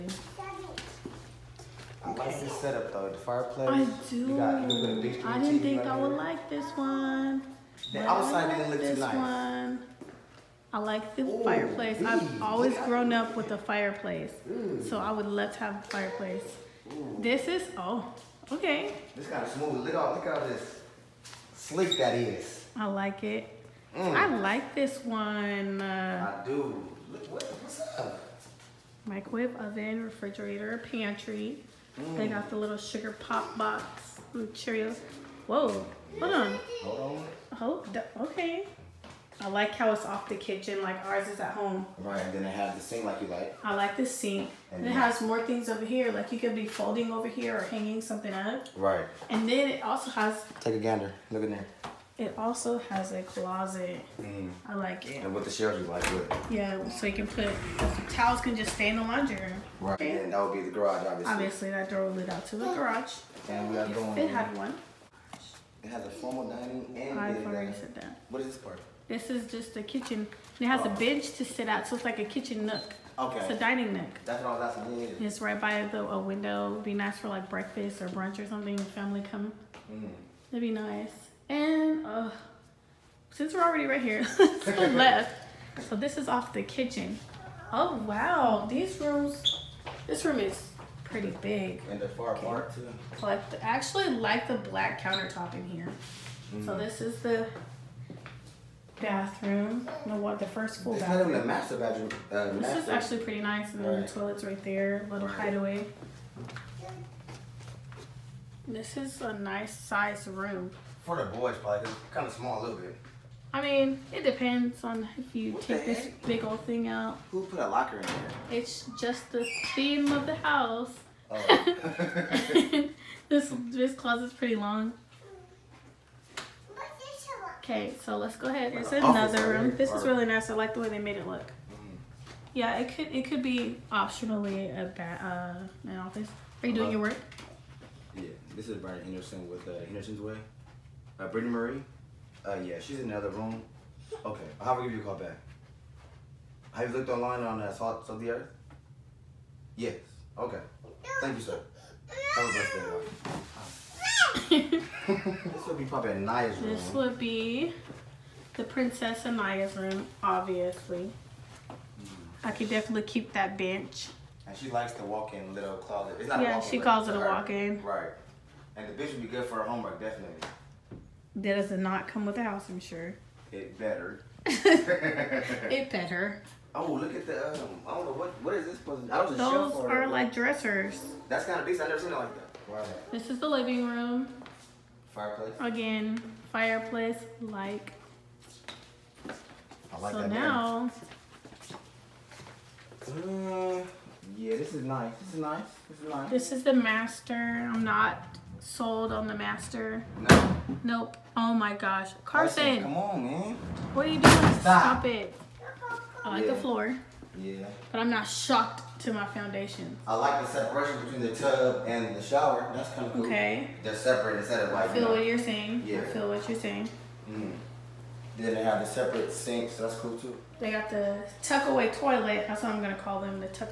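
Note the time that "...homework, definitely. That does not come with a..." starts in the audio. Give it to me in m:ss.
2:49.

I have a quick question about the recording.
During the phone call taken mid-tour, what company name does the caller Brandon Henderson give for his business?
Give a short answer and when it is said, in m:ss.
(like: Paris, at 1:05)
Henderson's Way, at 2:19.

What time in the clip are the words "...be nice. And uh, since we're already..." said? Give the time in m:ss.
1:20.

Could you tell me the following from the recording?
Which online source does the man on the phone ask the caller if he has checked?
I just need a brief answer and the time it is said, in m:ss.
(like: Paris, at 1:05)
Salt of the Earth, at 2:27.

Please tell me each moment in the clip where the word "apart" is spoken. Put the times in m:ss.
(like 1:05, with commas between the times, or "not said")
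1:32.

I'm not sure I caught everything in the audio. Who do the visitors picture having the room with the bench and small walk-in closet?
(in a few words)
Naya.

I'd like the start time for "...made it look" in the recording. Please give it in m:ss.
2:10.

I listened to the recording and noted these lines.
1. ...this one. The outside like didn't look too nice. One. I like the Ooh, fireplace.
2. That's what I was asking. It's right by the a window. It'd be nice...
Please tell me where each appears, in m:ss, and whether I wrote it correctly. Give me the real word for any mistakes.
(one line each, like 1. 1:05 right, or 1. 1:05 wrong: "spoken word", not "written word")
1. 0:06 right
2. 1:14 right.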